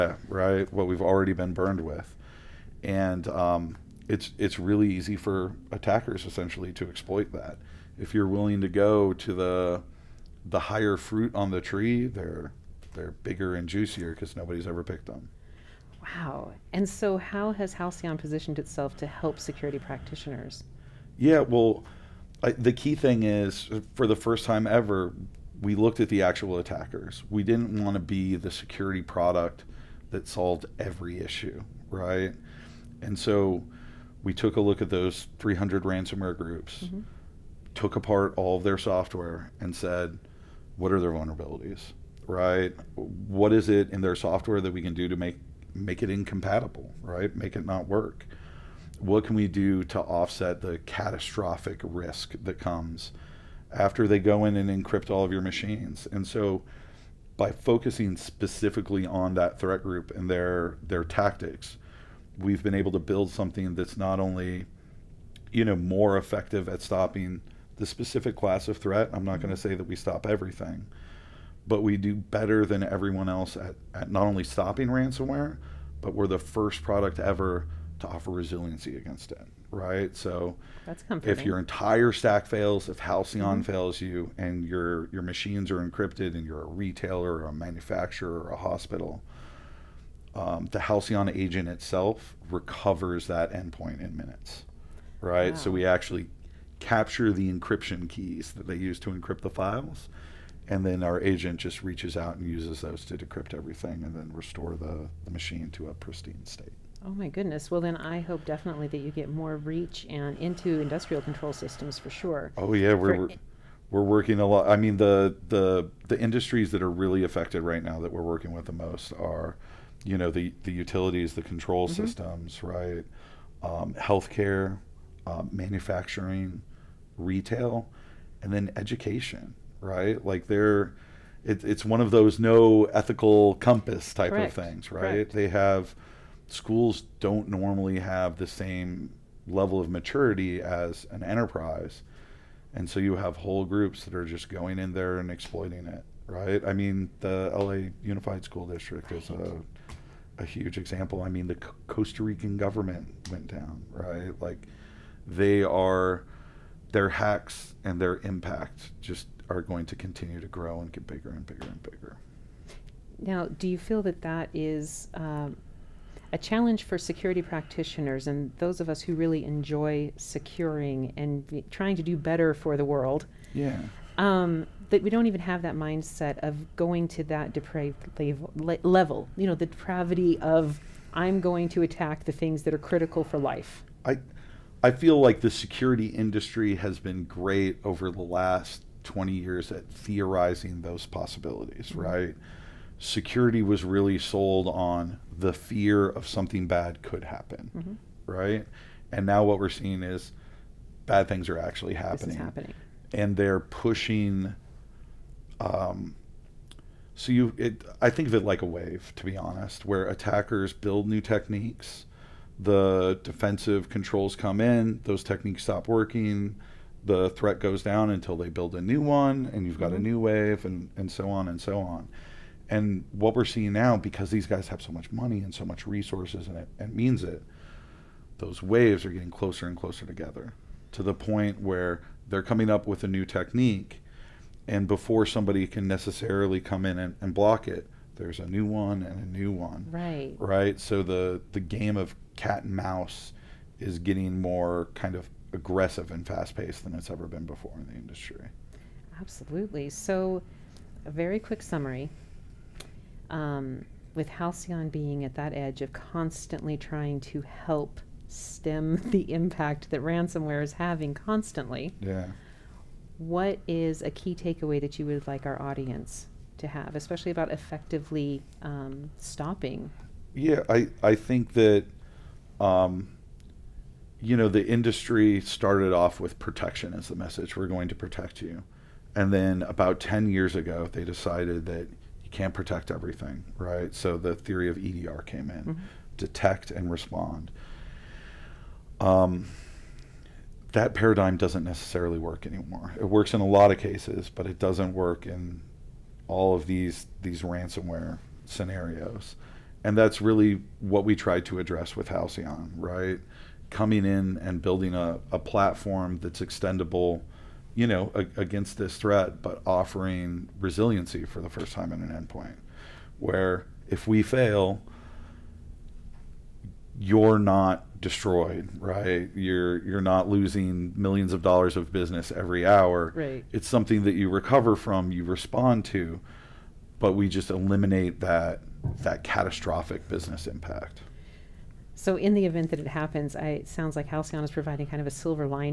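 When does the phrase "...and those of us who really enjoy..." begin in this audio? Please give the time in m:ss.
2:48.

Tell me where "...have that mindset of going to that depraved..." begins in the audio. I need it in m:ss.
2:55.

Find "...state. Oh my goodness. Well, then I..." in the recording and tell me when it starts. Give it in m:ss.
1:46.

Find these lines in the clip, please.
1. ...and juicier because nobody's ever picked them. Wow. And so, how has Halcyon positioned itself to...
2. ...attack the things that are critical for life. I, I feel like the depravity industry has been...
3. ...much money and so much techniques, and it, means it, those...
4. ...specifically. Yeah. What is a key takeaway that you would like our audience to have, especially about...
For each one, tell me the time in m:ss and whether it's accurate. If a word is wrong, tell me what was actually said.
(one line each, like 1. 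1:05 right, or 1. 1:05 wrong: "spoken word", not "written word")
1. 0:13 right
2. 3:01 wrong: "security", not "depravity"
3. 3:44 wrong: "resources", not "techniques"
4. 4:21 wrong: "constantly", not "specifically".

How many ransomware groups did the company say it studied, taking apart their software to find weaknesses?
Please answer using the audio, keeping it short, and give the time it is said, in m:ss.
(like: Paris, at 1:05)
300, at 0:35.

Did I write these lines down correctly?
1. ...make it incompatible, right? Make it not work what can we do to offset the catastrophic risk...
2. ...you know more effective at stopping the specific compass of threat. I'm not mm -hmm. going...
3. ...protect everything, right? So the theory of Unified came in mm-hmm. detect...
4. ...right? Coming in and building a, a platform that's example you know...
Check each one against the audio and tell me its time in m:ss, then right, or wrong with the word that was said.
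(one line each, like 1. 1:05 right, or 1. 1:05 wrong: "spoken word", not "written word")
1. 0:45 right
2. 1:05 wrong: "class", not "compass"
3. 4:42 wrong: "EDR", not "Unified"
4. 5:02 wrong: "extendable", not "example".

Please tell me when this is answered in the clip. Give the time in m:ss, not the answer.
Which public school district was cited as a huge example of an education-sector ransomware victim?
2:27.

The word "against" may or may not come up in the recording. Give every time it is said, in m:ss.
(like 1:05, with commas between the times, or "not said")
1:18, 5:08.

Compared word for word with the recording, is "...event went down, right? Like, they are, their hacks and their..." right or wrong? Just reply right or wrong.
wrong.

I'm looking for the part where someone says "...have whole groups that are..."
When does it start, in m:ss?
2:23.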